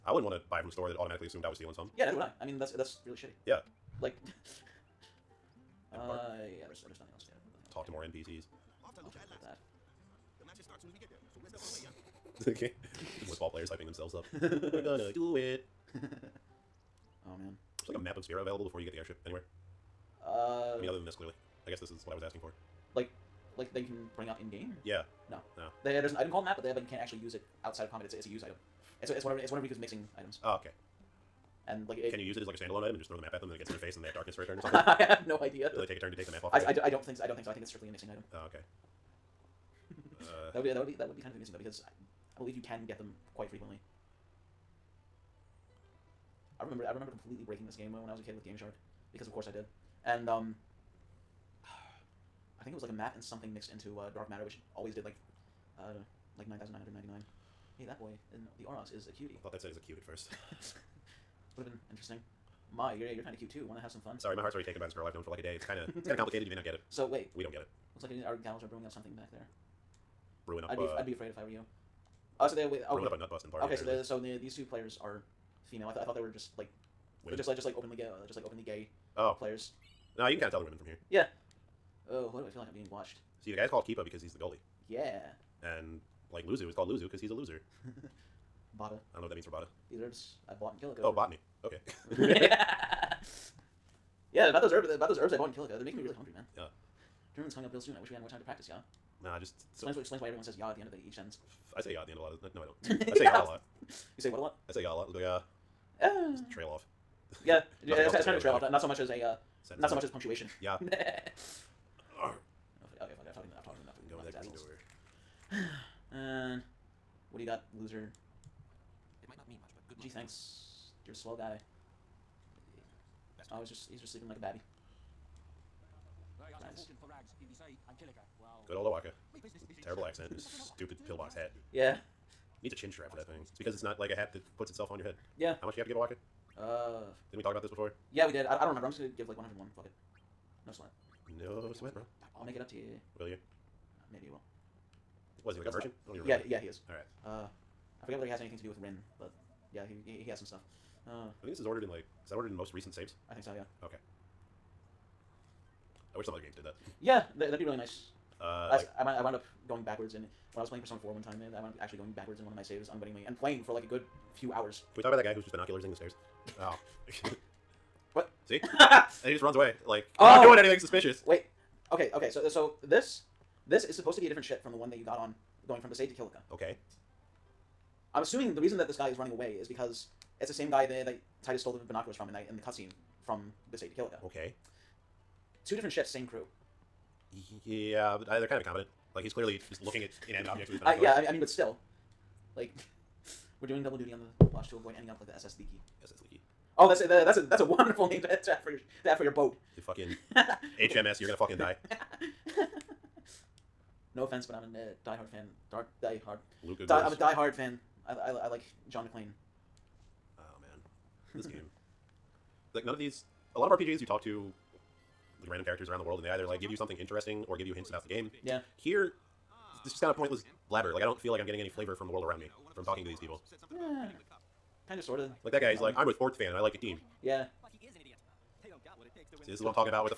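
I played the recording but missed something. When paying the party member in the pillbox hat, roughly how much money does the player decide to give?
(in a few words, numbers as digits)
101.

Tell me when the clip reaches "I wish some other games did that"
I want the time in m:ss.
2:36.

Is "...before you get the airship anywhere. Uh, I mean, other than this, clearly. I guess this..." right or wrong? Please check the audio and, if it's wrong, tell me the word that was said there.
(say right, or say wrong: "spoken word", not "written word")
right.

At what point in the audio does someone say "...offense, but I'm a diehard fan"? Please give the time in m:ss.
3:24.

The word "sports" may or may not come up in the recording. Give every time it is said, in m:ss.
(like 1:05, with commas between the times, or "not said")
3:46.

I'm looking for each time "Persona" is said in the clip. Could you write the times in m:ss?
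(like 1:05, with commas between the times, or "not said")
2:40.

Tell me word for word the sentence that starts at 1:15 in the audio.
I thought I thought they were just like women.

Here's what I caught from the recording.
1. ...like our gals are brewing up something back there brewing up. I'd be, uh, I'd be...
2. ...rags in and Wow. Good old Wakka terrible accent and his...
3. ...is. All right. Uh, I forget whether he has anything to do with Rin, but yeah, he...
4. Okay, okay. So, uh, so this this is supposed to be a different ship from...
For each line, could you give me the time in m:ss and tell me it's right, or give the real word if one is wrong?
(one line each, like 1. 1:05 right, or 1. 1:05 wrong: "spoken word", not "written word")
1. 1:08 right
2. 2:07 right
3. 2:26 right
4. 2:51 right.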